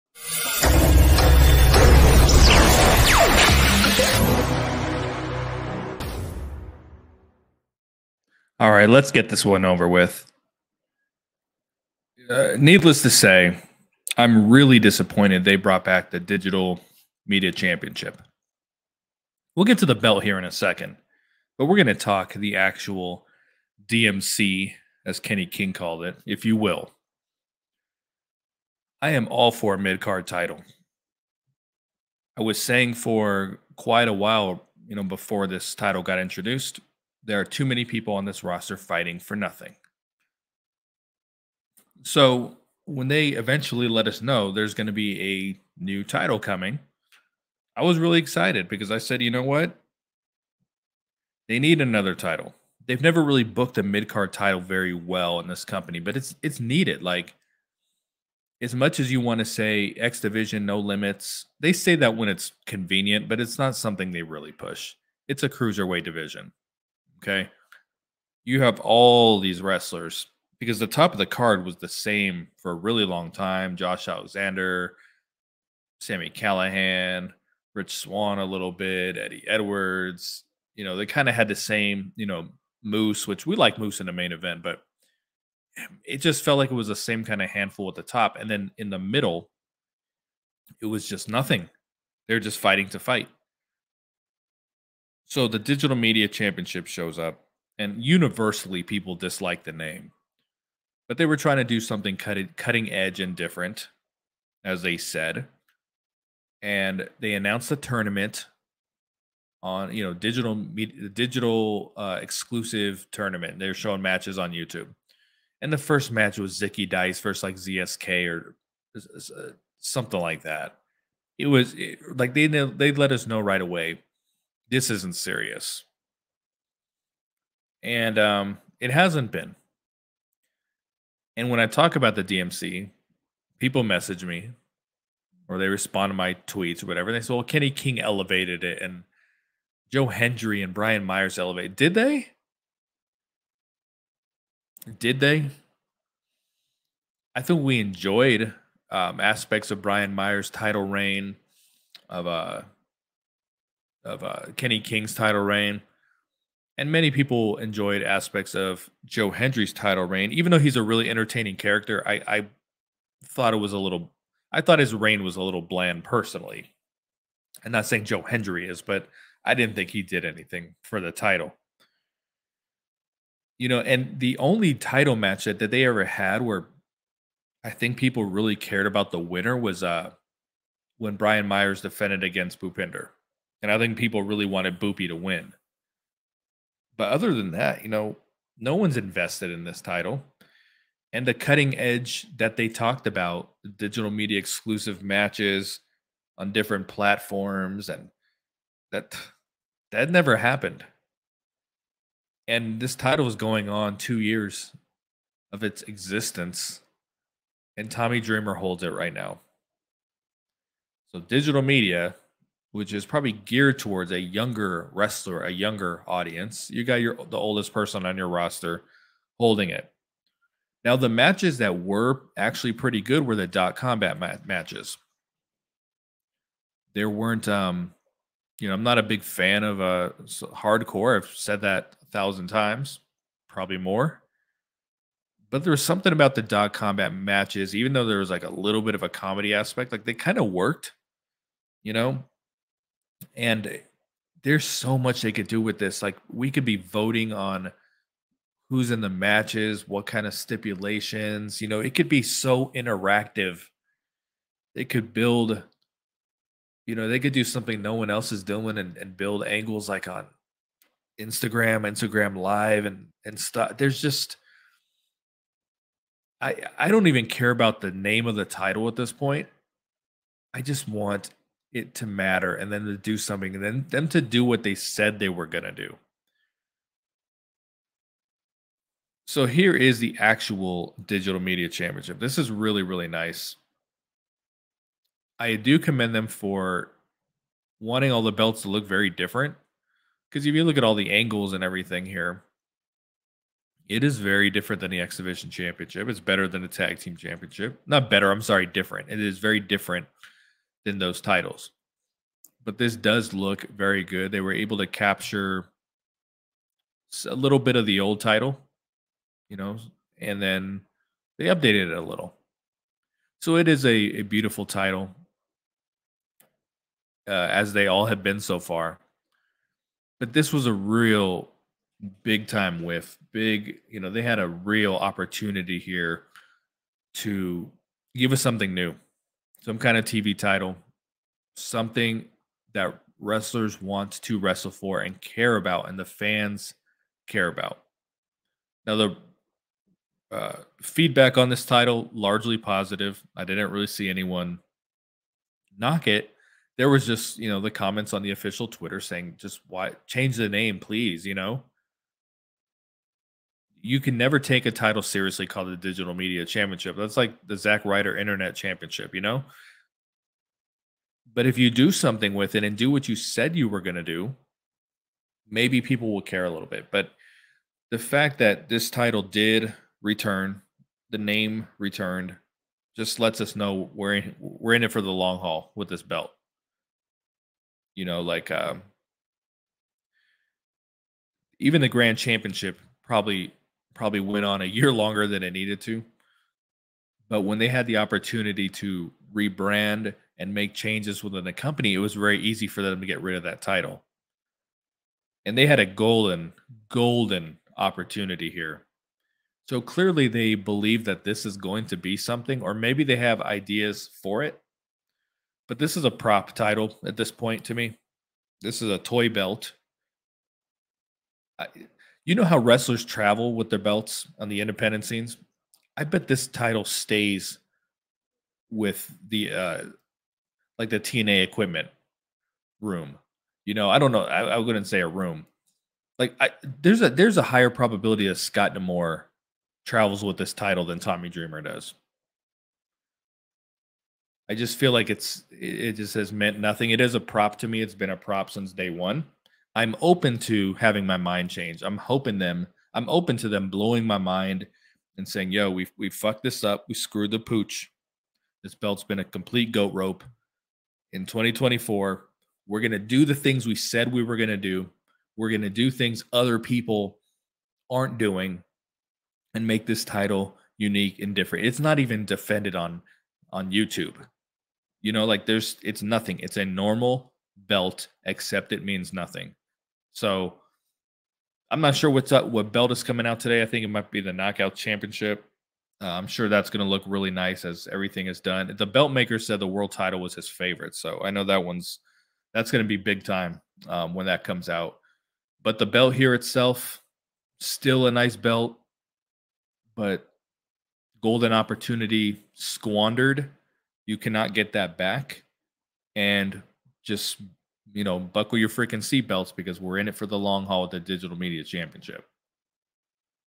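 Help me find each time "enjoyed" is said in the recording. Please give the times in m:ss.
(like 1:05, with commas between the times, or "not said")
2:27, 2:37.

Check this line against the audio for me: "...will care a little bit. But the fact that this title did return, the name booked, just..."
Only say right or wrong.
wrong.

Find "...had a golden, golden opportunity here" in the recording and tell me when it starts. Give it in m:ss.
6:35.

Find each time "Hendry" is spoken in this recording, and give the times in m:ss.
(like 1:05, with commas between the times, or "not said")
2:20, 2:39, 2:48.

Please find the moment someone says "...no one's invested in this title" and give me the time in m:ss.
3:08.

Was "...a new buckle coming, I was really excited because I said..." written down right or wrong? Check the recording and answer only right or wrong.
wrong.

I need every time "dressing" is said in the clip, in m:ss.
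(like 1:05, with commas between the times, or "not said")
not said.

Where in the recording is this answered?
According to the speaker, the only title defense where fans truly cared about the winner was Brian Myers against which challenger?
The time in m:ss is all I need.
3:02.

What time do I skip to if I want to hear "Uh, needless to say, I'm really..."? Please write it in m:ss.
0:12.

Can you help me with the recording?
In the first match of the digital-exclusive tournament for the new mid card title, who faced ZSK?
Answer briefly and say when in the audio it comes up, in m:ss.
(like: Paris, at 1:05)
Zicky Dice, at 1:56.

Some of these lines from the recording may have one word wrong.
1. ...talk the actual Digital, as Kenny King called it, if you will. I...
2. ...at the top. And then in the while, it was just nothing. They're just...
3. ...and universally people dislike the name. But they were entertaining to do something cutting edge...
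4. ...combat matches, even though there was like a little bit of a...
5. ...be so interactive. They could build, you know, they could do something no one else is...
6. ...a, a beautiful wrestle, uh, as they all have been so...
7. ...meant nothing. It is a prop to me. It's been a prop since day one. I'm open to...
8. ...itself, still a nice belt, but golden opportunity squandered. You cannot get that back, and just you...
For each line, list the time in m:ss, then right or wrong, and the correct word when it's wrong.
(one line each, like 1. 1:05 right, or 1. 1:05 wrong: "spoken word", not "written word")
1. 0:21 wrong: "DMC", not "Digital"
2. 1:27 wrong: "middle", not "while"
3. 1:37 wrong: "trying", not "entertaining"
4. 3:56 right
5. 4:12 right
6. 5:13 wrong: "title", not "wrestle"
7. 7:16 right
8. 8:06 right.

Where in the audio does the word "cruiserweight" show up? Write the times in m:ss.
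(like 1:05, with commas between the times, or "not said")
1:05.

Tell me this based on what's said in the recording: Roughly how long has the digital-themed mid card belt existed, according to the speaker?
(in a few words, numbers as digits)
Two years.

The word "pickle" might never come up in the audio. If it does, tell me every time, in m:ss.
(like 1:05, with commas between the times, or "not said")
not said.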